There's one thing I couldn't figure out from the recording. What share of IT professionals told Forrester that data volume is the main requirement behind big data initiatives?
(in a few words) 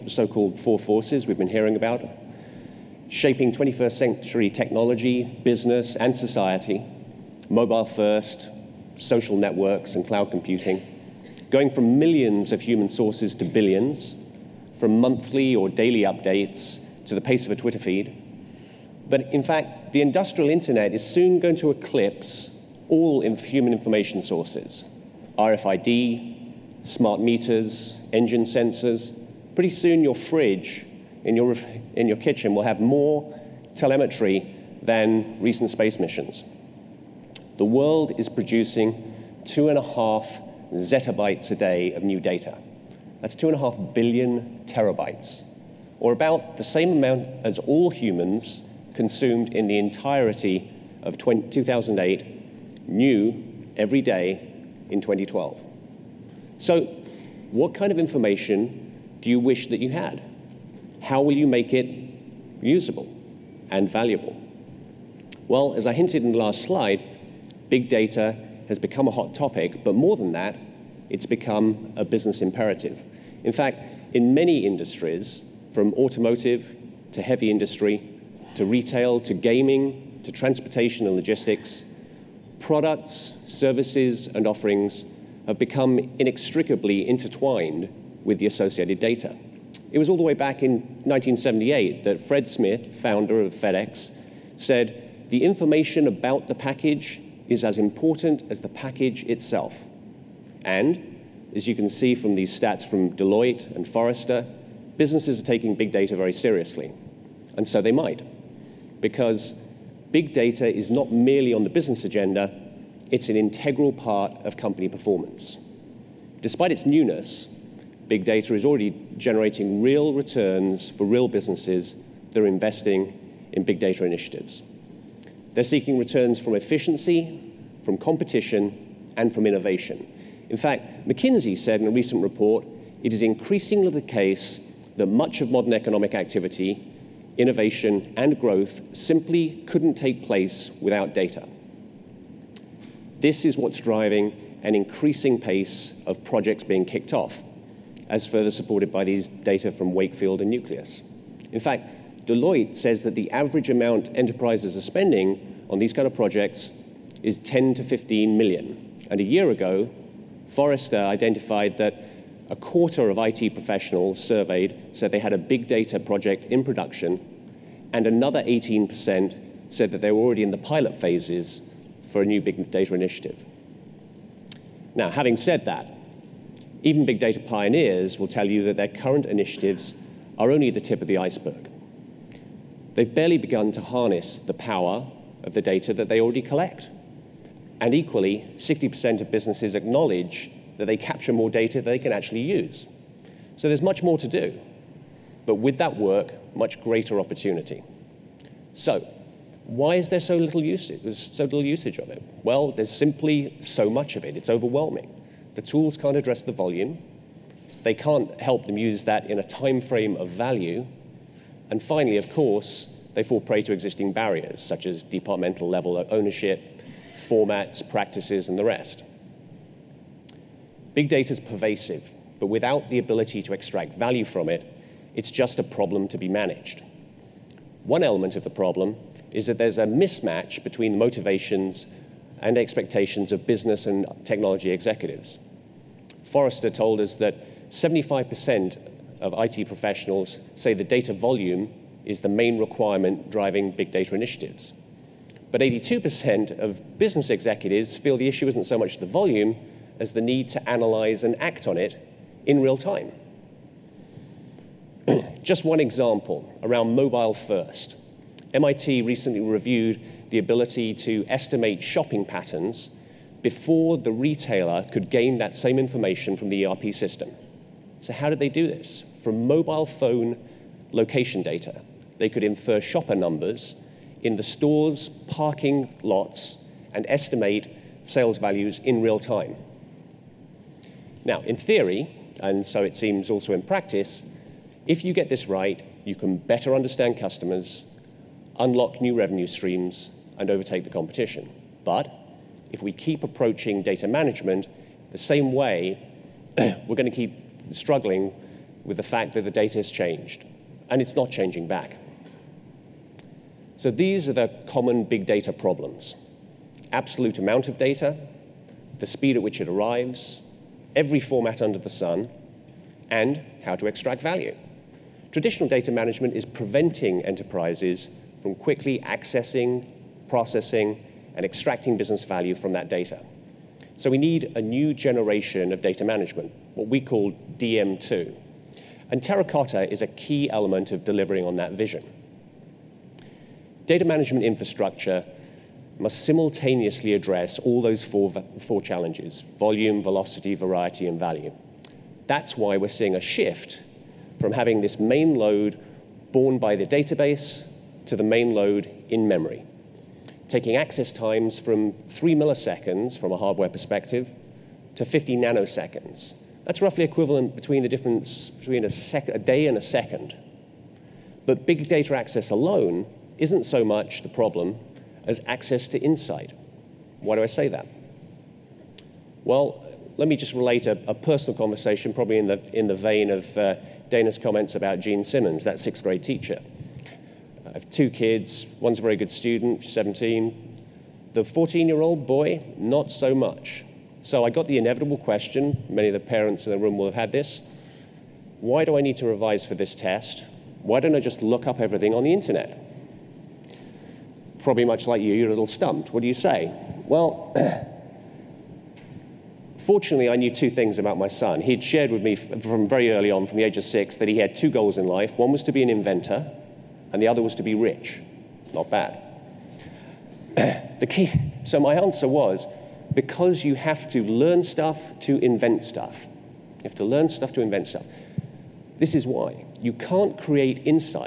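75%.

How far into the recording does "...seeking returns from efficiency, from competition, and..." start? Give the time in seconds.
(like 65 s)
125 s.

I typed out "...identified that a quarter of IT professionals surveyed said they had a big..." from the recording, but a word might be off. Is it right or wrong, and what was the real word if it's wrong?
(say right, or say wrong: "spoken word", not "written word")
right.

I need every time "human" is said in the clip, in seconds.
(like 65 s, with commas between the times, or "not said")
12 s, 23 s, 47 s.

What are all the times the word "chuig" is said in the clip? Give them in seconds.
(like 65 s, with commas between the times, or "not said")
not said.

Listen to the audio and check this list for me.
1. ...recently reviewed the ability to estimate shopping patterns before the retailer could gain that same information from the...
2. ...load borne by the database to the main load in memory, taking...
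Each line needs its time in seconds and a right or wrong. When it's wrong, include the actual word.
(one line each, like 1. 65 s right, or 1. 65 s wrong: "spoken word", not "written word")
1. 259 s right
2. 345 s right.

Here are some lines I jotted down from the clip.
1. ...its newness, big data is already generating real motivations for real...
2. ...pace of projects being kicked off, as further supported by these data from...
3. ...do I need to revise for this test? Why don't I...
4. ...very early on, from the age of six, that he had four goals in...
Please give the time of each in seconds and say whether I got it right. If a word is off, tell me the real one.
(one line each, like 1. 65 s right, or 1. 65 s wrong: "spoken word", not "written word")
1. 116 s wrong: "returns", not "motivations"
2. 145 s right
3. 388 s right
4. 402 s wrong: "two", not "four".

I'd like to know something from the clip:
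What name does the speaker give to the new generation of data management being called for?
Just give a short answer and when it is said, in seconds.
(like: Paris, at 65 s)
DM2, at 327 s.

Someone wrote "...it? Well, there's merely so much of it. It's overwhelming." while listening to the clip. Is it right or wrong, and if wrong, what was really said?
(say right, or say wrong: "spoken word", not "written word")
wrong: "simply", not "merely".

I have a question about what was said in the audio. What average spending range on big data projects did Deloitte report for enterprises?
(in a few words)
10 to 15 million.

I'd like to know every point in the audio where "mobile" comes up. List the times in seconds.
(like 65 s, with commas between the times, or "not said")
7 s, 256 s, 269 s.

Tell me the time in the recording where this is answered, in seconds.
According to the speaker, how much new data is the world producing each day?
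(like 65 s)
39 s.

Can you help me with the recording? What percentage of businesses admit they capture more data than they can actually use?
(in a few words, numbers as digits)
60%.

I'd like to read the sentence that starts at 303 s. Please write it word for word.
So these are the common big data problems.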